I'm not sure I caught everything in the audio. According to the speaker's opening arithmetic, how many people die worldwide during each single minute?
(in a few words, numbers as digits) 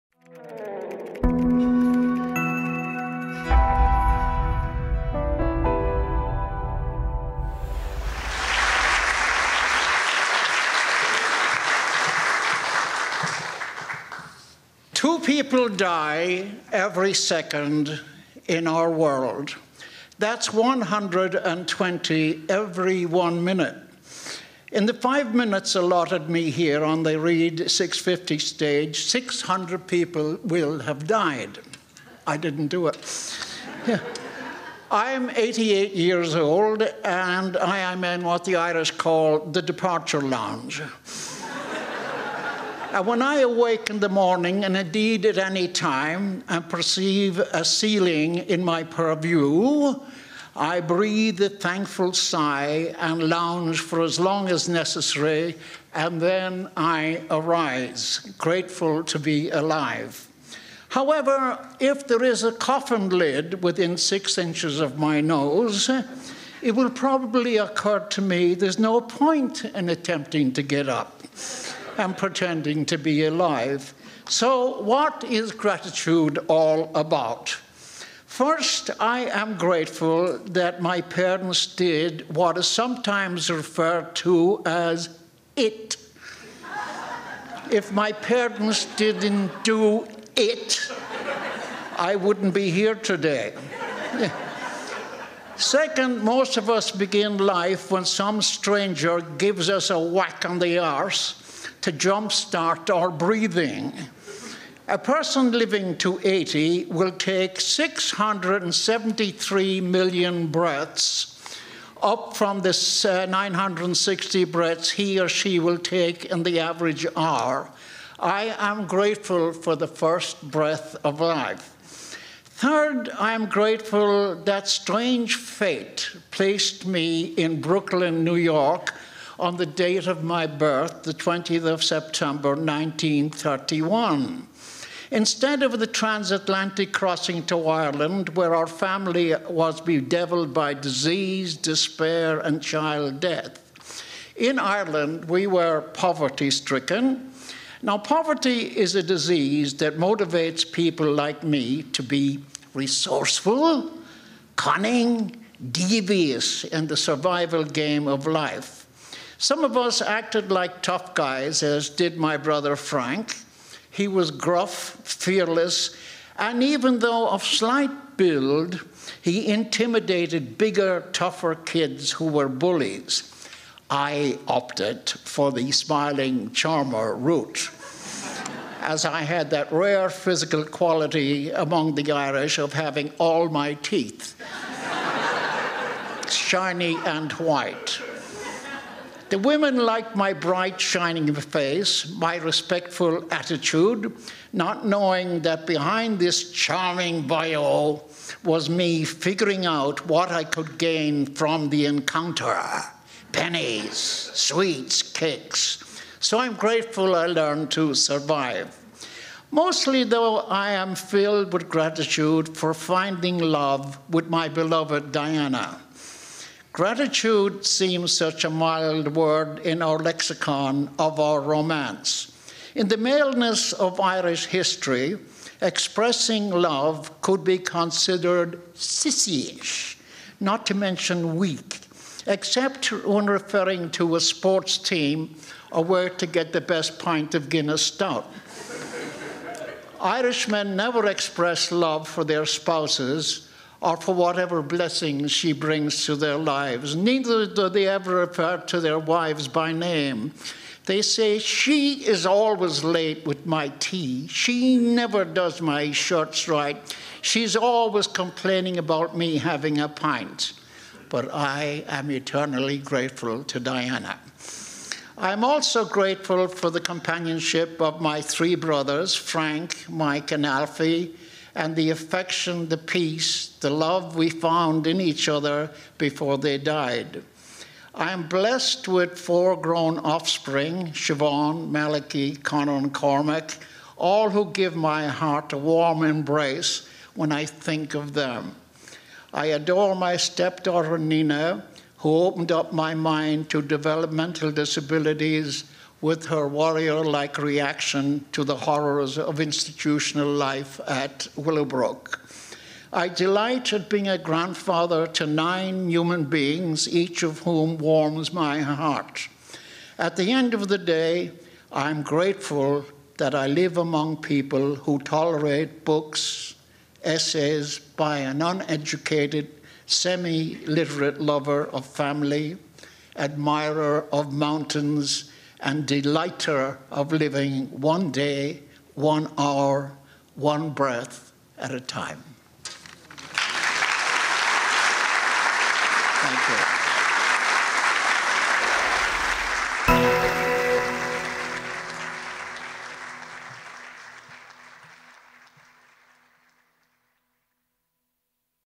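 120.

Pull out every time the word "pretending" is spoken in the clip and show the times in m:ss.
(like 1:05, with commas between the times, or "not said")
1:12.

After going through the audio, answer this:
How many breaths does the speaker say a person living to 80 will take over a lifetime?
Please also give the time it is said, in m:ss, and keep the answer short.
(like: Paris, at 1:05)
673 million, at 1:47.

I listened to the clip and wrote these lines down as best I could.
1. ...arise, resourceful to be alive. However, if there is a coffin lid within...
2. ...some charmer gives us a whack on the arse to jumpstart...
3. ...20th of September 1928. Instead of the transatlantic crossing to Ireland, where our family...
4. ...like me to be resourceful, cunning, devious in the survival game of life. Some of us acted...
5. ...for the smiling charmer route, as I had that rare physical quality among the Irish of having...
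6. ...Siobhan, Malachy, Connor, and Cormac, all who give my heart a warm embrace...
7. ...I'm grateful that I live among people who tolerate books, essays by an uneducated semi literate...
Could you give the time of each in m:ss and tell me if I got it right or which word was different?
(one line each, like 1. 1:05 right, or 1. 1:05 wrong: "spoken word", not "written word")
1. 0:57 wrong: "grateful", not "resourceful"
2. 1:38 wrong: "stranger", not "charmer"
3. 2:11 wrong: "1931", not "1928"
4. 2:31 right
5. 2:55 right
6. 4:40 right
7. 5:11 right.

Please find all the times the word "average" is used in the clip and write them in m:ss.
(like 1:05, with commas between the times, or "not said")
1:56.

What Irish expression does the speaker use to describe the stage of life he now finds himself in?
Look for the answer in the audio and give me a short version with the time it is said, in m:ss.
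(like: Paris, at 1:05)
the departure lounge, at 0:39.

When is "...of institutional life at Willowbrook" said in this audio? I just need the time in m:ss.
4:59.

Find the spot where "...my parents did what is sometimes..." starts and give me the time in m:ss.
1:20.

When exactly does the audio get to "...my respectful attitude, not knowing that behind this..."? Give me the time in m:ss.
3:12.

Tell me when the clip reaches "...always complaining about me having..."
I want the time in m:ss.
4:17.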